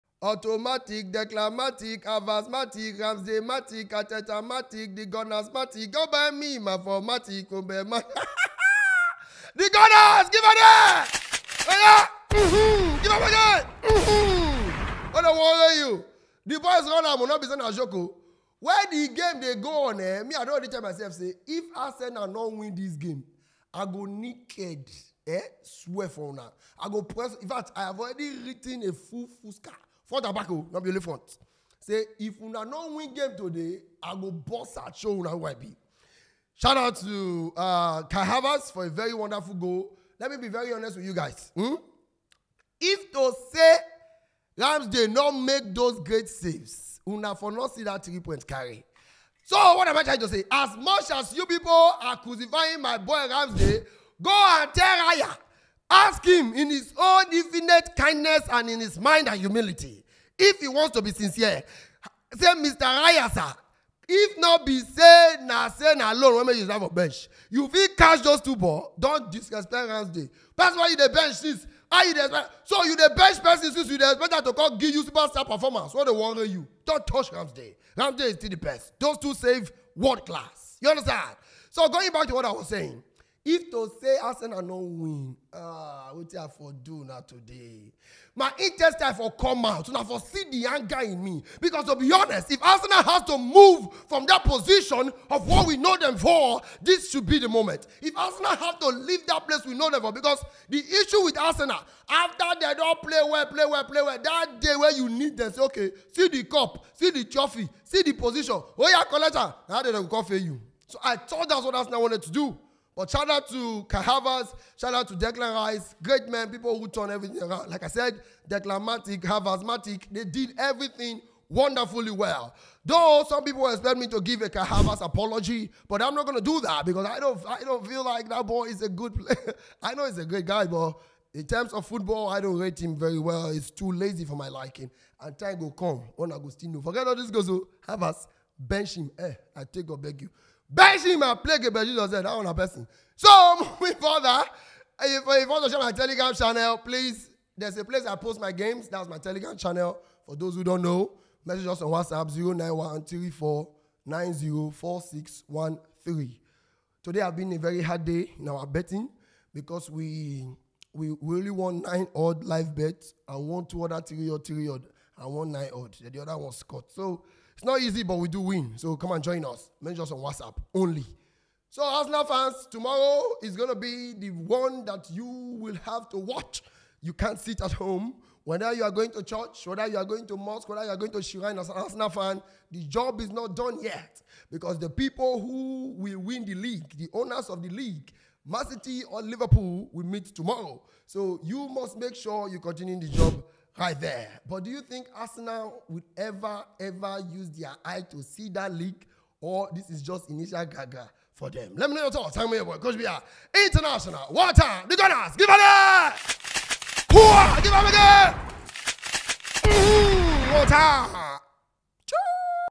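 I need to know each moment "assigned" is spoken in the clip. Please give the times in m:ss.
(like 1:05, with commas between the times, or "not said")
not said.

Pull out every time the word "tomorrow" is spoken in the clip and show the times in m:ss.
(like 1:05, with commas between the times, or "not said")
2:52, 3:10.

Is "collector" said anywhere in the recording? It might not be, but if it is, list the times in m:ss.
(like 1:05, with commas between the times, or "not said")
1:49.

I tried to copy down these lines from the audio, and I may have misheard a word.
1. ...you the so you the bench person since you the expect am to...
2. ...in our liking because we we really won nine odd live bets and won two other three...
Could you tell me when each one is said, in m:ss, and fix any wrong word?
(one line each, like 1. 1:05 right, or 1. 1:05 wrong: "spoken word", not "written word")
1. 1:12 right
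2. 2:38 wrong: "betting", not "liking".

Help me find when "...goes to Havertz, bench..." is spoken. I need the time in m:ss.
2:17.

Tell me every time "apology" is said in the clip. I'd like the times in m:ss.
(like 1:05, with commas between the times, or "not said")
2:05.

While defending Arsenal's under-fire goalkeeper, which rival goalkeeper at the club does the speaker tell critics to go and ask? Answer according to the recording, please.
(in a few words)
Raya.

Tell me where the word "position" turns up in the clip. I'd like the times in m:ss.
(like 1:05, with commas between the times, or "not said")
1:34, 1:48.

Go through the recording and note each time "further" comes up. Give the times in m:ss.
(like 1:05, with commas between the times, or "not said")
2:23.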